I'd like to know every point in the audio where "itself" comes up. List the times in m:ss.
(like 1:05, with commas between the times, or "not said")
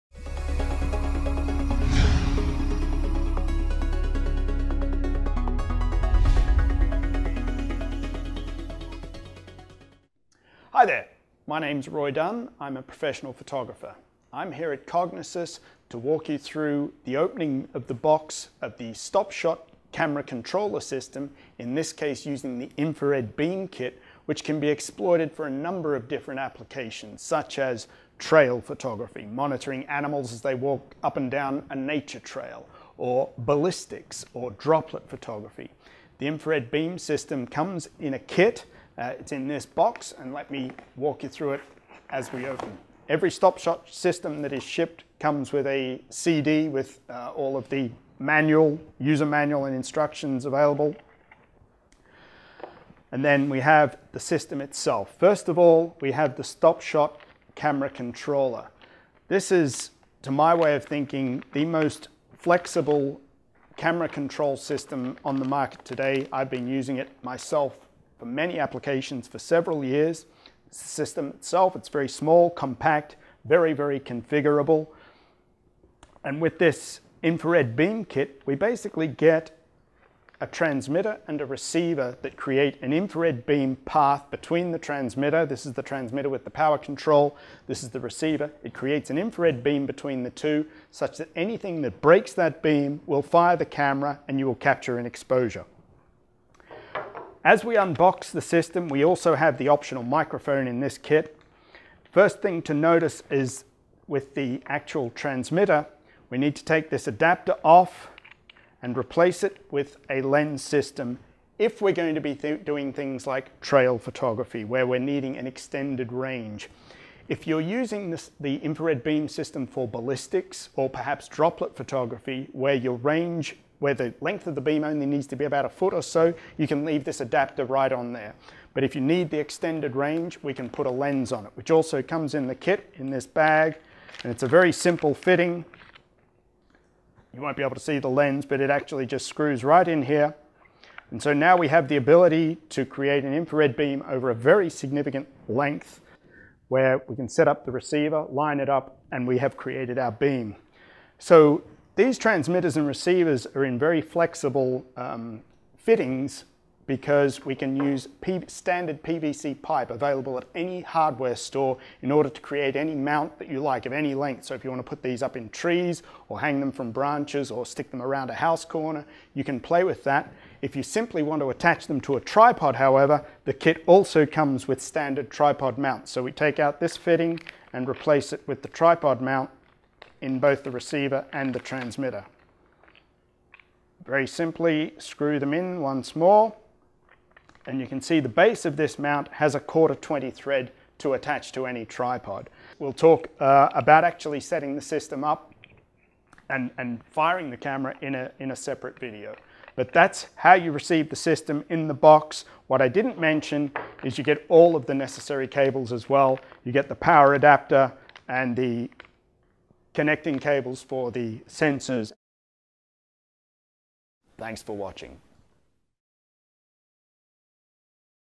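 0:54, 1:11.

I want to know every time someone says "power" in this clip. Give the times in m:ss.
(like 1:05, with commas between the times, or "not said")
1:26, 3:26.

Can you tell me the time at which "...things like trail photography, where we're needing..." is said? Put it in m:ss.
1:52.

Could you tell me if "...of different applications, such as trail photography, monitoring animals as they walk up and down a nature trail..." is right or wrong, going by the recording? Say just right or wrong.
right.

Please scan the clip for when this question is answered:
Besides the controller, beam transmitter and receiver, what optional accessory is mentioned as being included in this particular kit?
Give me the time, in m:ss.
1:40.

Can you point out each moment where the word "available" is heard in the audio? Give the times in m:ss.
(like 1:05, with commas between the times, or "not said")
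0:50, 2:39.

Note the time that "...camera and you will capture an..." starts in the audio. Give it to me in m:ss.
1:33.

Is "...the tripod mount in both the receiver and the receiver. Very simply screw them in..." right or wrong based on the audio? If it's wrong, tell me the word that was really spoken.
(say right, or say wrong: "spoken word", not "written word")
wrong: "transmitter", not "receiver".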